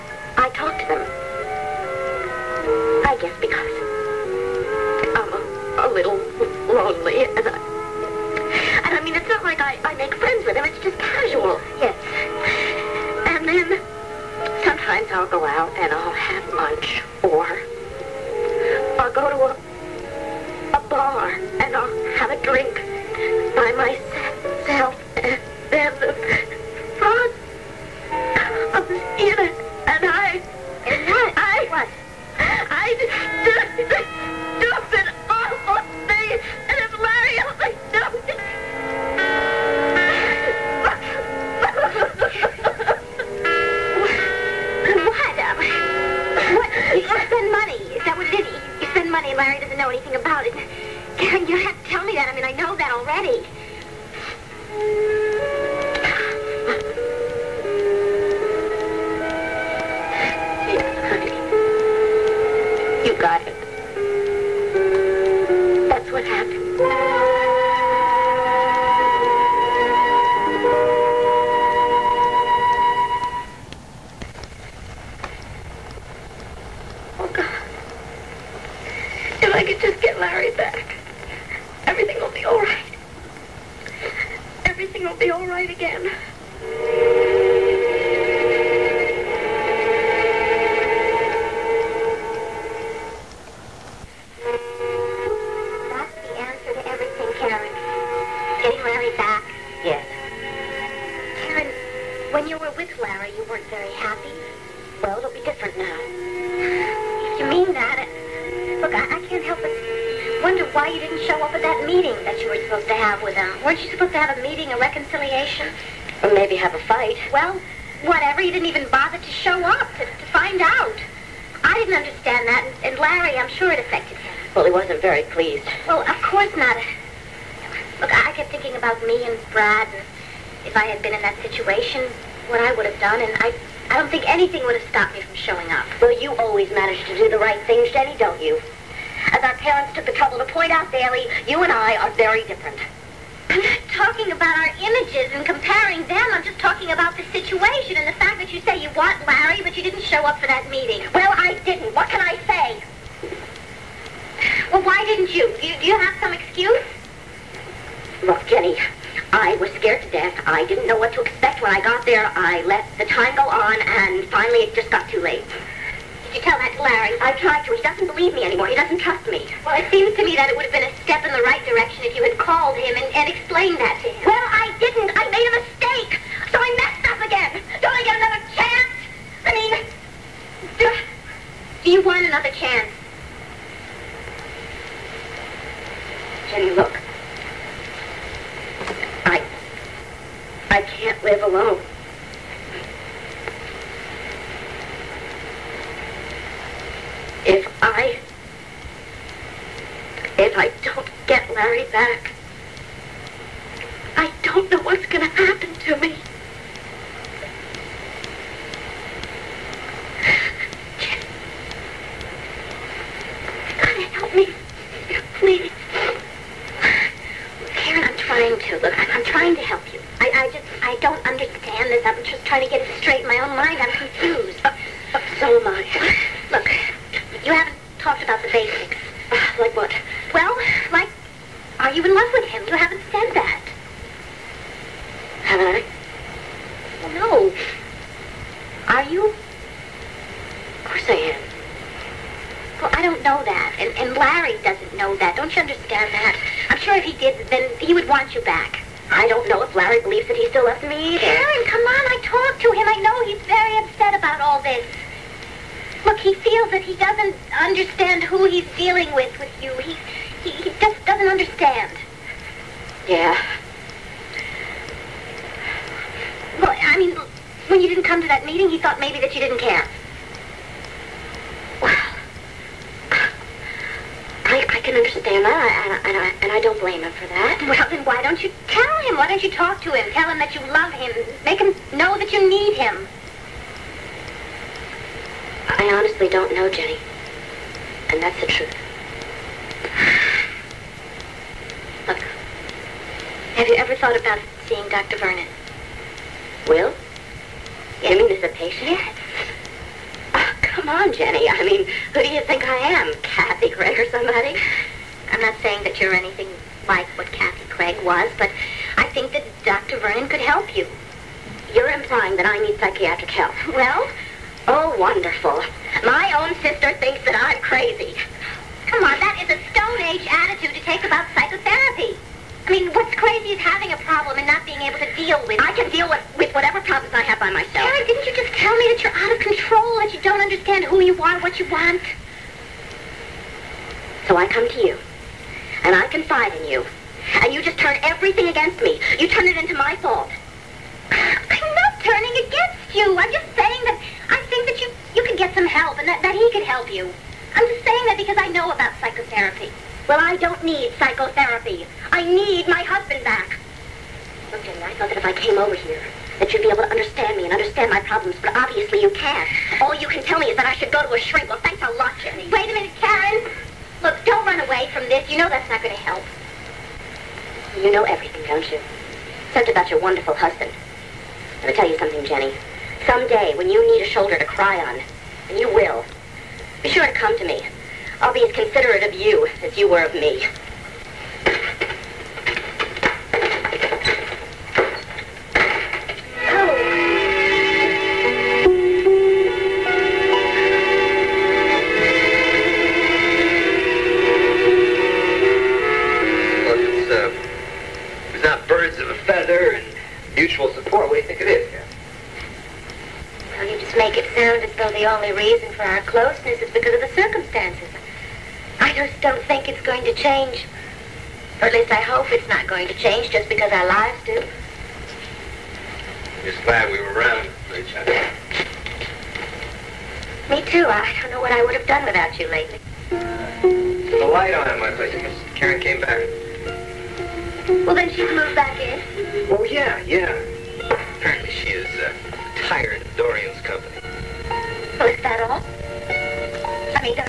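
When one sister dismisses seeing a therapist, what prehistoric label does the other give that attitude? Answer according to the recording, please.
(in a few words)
Stone Age.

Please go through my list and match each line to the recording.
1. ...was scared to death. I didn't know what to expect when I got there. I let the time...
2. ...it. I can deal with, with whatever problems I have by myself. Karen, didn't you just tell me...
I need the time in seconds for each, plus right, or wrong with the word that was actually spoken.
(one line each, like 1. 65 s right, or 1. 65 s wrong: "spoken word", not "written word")
1. 159 s right
2. 325 s right.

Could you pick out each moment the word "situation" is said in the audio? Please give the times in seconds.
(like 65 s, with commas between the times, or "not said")
131 s, 147 s.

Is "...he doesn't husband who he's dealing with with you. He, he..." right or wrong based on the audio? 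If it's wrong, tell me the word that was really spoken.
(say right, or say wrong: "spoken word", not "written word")
wrong: "understand", not "husband".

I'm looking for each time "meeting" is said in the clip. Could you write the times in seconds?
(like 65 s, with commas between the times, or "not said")
150 s, 268 s.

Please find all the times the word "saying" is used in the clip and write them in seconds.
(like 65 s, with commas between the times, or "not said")
305 s, 343 s, 347 s.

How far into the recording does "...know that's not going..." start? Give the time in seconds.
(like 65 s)
365 s.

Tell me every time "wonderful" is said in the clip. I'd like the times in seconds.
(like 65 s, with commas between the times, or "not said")
314 s, 370 s.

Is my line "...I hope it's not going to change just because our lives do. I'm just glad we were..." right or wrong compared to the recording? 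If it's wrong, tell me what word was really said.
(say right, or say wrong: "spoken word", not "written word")
right.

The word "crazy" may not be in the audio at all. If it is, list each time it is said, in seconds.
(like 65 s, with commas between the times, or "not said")
317 s, 323 s.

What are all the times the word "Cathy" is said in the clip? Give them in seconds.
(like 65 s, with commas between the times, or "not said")
303 s, 307 s.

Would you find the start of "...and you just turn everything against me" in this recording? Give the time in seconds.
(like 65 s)
337 s.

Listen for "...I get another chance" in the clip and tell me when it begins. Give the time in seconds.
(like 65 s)
177 s.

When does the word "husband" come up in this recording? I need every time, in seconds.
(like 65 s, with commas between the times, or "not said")
352 s, 370 s.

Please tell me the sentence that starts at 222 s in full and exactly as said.
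trying to get it straight in my own mind.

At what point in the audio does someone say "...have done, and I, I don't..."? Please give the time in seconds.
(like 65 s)
132 s.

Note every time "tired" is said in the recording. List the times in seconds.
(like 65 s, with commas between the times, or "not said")
432 s.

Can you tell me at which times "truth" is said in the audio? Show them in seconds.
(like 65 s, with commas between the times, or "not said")
288 s.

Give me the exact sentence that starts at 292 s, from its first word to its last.
Look, have you ever thought about seeing Dr.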